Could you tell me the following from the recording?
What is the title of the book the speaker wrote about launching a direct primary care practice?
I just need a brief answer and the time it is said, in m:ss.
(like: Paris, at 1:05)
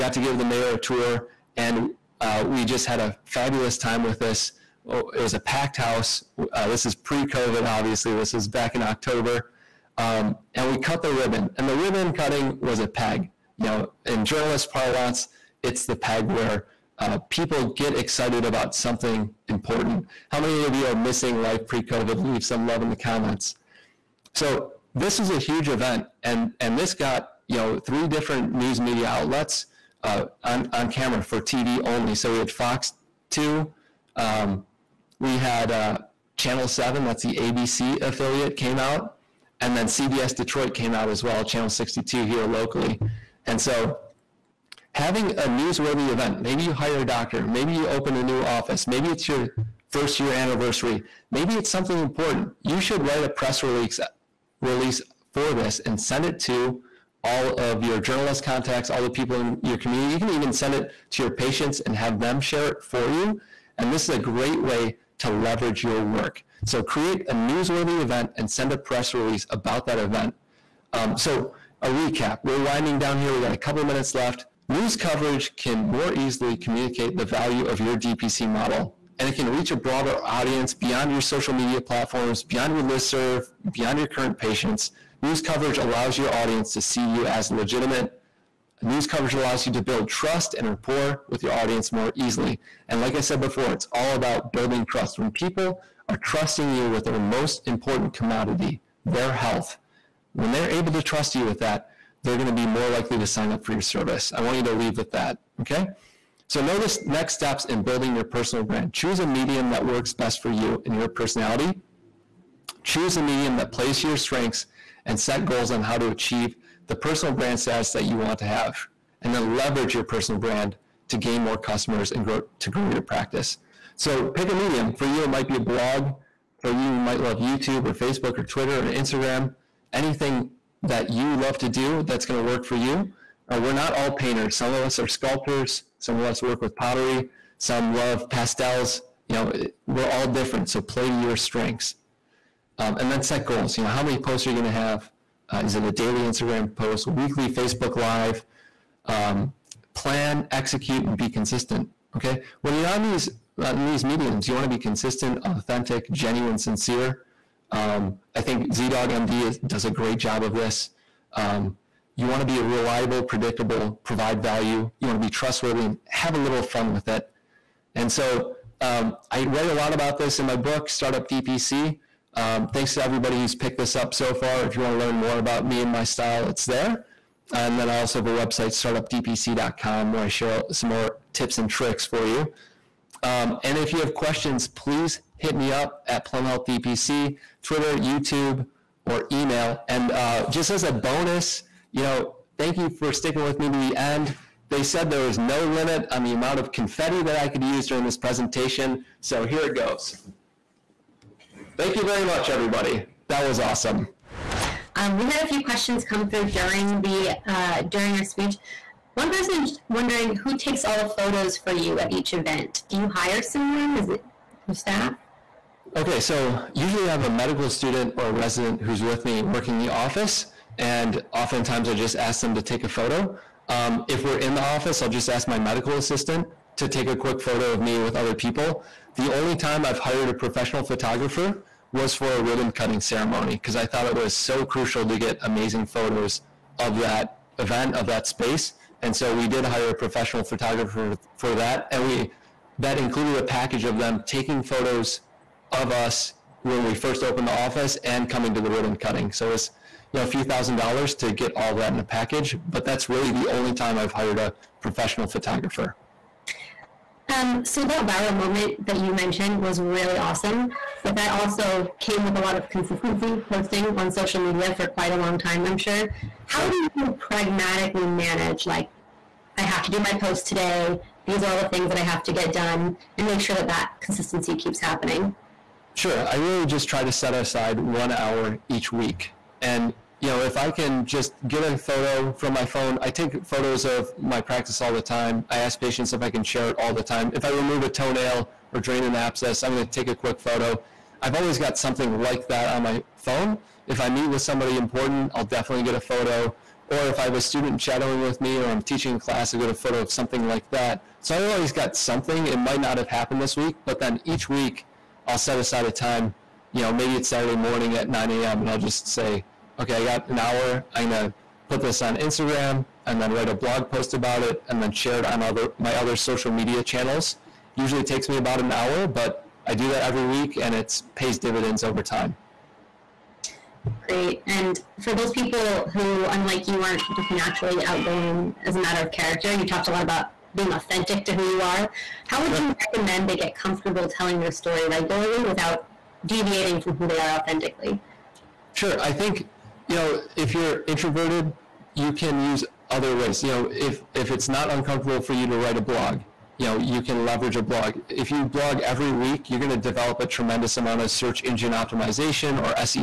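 Startup DPC, at 2:50.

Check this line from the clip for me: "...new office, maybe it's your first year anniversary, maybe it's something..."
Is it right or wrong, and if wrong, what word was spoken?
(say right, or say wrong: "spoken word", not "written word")
right.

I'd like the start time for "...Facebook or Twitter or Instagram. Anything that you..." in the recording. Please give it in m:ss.
2:07.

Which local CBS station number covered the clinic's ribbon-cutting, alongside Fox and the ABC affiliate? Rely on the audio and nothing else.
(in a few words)
62.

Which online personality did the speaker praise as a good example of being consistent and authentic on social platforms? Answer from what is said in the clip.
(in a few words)
ZDoggMD.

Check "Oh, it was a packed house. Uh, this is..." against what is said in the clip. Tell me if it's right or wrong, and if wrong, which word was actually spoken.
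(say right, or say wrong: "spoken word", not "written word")
right.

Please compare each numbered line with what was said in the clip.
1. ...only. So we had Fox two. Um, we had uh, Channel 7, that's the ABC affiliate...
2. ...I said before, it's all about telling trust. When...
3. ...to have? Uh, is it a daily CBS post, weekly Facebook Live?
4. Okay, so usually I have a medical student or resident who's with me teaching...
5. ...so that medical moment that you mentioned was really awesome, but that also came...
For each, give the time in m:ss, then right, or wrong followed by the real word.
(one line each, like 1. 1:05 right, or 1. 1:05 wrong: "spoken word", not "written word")
1. 0:31 right
2. 1:33 wrong: "building", not "telling"
3. 2:24 wrong: "Instagram", not "CBS"
4. 3:35 wrong: "working", not "teaching"
5. 4:17 wrong: "viral", not "medical".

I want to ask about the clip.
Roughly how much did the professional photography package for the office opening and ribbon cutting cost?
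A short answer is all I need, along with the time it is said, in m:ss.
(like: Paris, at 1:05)
a few thousand dollars, at 4:10.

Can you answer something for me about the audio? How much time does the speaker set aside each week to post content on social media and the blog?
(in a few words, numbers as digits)
1 hour.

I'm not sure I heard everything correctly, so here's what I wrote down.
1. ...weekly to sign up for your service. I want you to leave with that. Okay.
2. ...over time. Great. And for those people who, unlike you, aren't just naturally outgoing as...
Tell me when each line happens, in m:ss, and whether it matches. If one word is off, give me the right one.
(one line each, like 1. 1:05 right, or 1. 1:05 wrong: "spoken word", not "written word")
1. 1:42 wrong: "likely", not "weekly"
2. 5:21 right.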